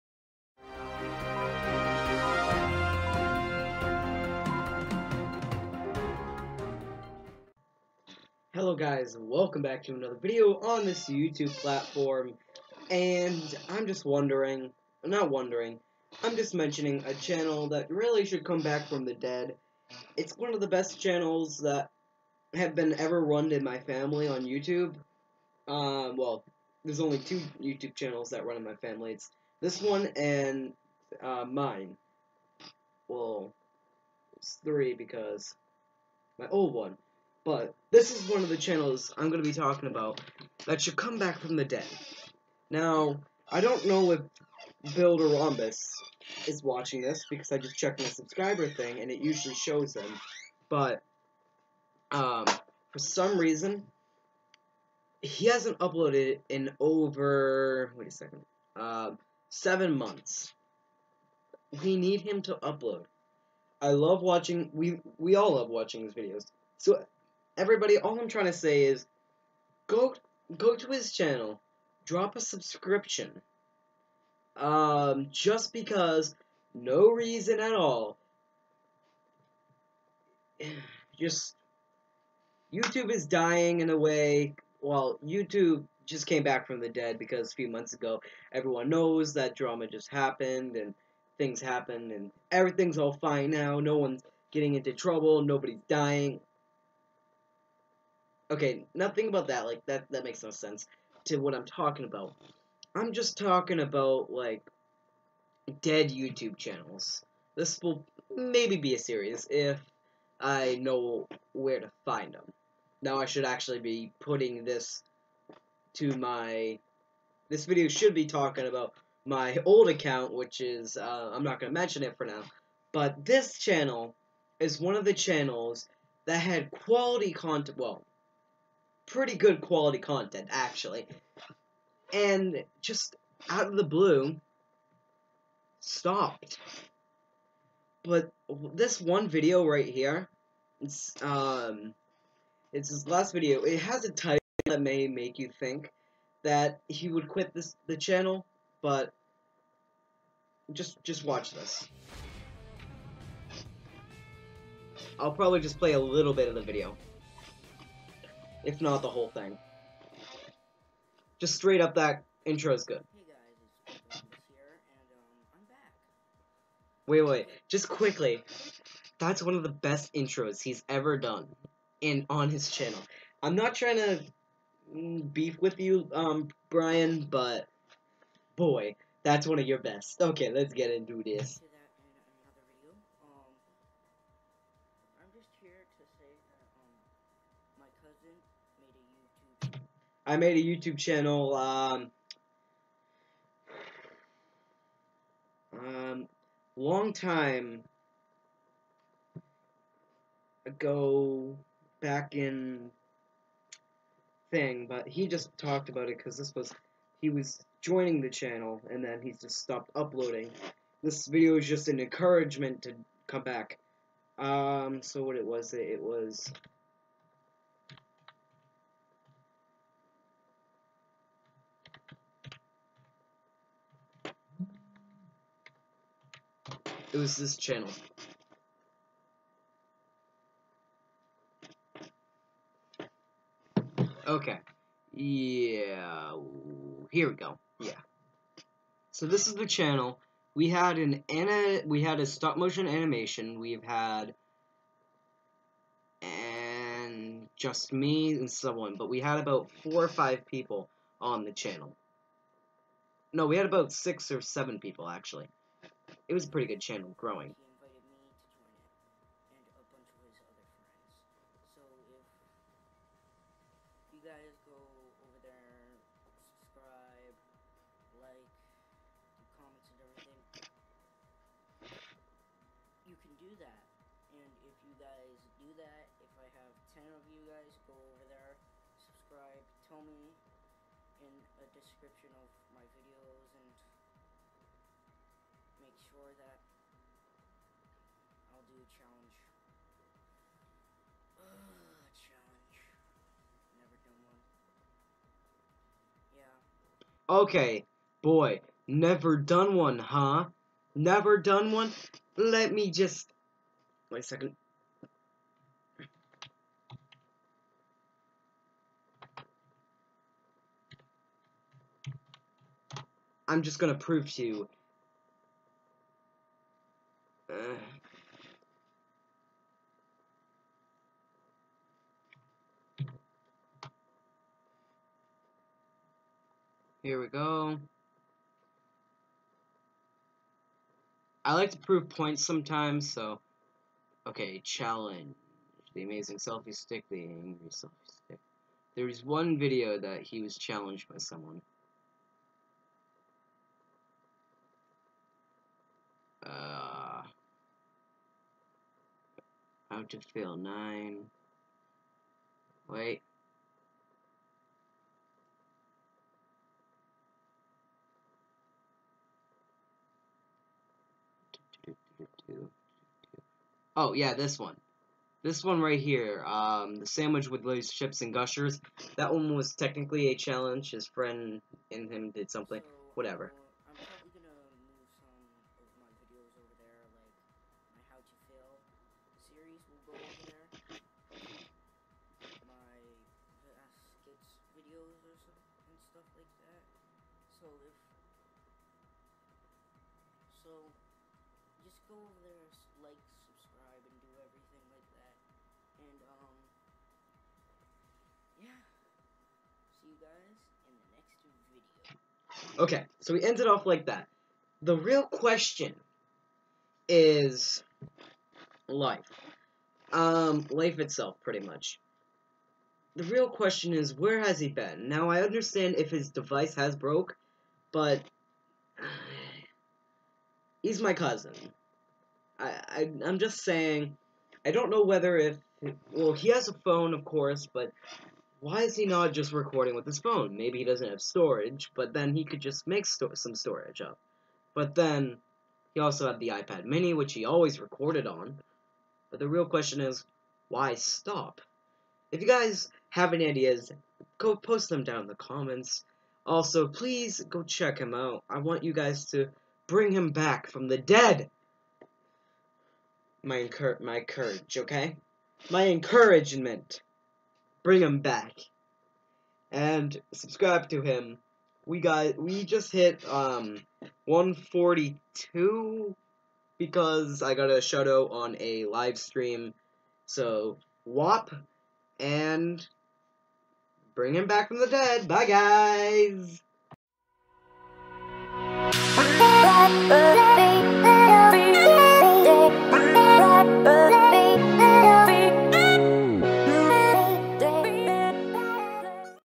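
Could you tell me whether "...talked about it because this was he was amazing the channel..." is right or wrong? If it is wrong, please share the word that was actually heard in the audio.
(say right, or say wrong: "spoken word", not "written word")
wrong: "joining", not "amazing".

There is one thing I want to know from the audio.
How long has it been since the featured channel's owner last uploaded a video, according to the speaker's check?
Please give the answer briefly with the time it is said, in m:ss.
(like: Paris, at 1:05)
7 months, at 0:59.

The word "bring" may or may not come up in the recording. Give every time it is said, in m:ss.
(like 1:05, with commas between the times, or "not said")
7:29, 7:37, 7:54.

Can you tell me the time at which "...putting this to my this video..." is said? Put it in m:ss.
1:54.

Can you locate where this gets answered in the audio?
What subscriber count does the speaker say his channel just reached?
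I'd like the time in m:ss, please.
7:44.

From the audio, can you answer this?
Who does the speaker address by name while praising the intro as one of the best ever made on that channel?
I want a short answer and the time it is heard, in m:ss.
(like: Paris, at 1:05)
Brian, at 2:56.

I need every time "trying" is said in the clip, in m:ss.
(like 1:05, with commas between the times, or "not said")
1:08, 2:53.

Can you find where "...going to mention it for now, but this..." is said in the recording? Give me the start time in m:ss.
2:01.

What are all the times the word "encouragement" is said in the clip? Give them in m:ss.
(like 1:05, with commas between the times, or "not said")
3:31, 7:35.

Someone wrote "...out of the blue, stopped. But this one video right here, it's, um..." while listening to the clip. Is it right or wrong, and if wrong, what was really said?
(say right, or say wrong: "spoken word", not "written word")
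right.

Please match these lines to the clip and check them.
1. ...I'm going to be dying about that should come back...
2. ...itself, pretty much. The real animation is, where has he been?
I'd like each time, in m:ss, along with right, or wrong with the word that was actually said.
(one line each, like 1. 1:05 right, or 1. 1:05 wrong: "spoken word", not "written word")
1. 0:39 wrong: "talking", not "dying"
2. 6:50 wrong: "question", not "animation".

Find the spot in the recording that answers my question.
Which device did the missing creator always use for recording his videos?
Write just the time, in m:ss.
7:16.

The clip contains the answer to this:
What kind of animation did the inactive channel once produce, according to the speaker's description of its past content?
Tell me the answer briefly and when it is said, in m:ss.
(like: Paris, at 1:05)
Stop motion, at 4:02.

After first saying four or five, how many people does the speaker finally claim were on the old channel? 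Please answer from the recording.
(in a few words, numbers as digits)
6 or 7.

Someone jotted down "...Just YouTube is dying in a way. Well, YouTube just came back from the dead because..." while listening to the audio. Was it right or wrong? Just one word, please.
right.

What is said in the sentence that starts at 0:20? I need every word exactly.
It's one of the best channels that have been ever run in my family on YouTube.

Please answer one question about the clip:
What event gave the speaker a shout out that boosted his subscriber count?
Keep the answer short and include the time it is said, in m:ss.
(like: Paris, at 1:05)
A live stream, at 7:48.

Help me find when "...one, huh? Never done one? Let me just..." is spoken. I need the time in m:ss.
4:59.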